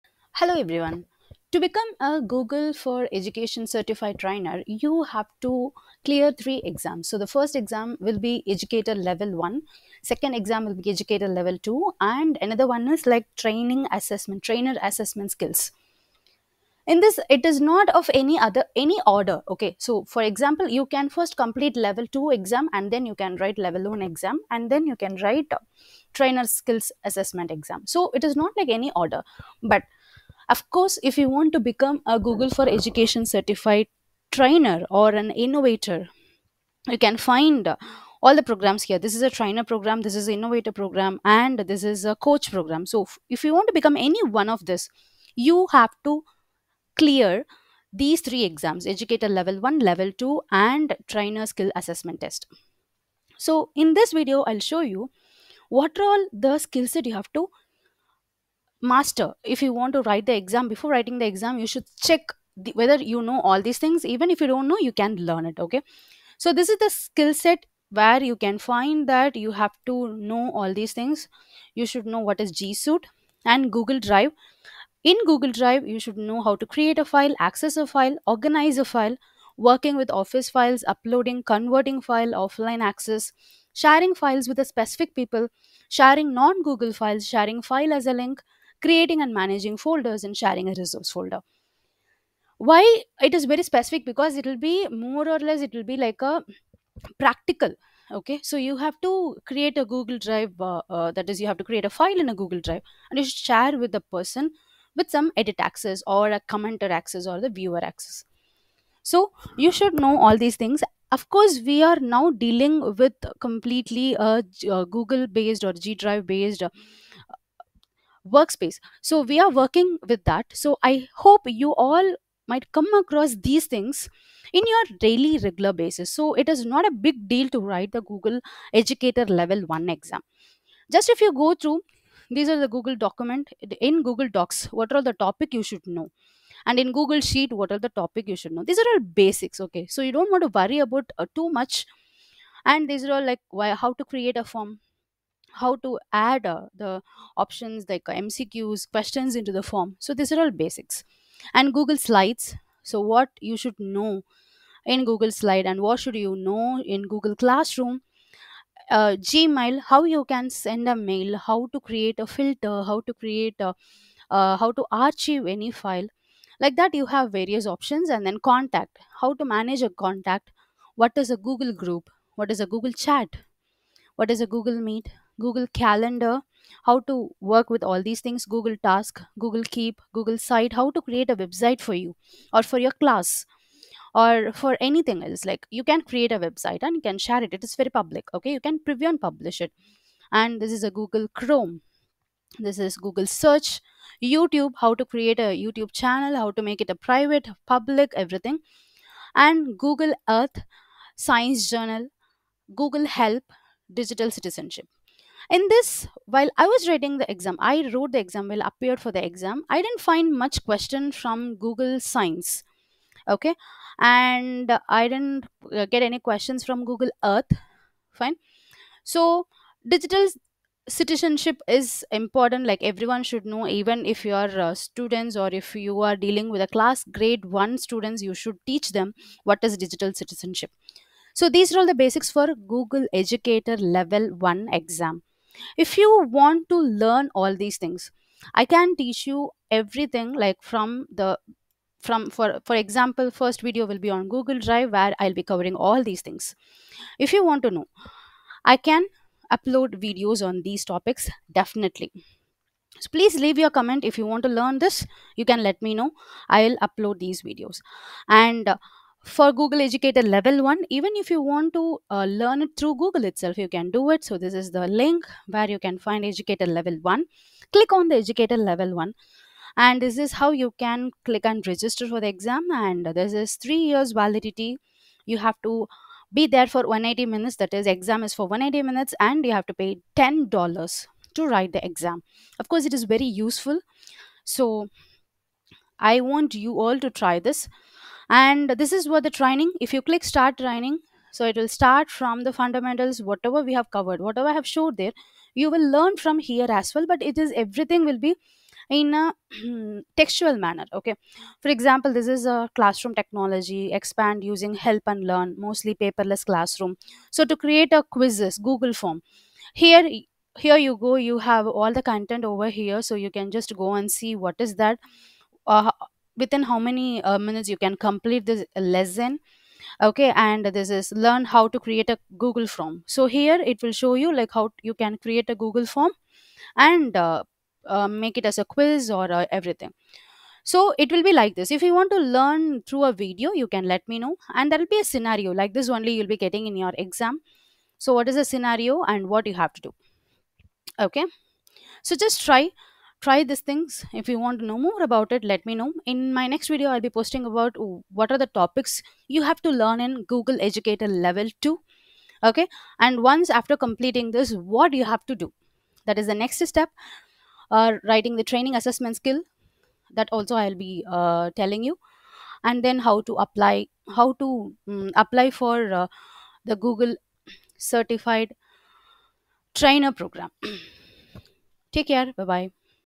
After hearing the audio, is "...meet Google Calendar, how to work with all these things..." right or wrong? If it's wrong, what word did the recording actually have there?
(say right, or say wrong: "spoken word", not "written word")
right.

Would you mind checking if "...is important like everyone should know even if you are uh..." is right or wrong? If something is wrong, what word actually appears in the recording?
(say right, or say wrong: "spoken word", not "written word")
right.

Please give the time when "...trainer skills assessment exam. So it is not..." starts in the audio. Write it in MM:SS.
00:26.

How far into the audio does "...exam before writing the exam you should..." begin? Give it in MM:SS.
01:00.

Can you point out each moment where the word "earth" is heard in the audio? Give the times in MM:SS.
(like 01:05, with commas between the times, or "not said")
03:20, 03:37.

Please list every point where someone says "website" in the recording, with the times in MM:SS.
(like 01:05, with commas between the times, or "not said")
03:01, 03:06.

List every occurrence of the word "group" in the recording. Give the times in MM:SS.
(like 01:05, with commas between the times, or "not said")
02:51.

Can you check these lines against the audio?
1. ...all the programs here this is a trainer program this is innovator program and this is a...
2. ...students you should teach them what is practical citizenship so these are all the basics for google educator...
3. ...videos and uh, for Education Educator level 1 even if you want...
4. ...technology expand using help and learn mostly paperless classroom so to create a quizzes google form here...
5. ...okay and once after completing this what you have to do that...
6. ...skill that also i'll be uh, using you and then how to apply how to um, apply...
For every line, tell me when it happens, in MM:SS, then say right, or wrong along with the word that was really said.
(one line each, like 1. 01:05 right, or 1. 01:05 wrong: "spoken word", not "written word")
1. 00:38 right
2. 03:47 wrong: "digital", not "practical"
3. 04:17 wrong: "Google", not "Education"
4. 05:03 right
5. 05:52 right
6. 05:59 wrong: "telling", not "using".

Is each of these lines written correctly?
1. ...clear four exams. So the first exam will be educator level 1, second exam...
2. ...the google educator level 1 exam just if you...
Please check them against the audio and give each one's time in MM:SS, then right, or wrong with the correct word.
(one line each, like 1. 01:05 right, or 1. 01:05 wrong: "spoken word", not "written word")
1. 00:06 wrong: "three", not "four"
2. 02:07 right.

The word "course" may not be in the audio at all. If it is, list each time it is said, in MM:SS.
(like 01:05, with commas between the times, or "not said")
00:30, 01:51, 04:42.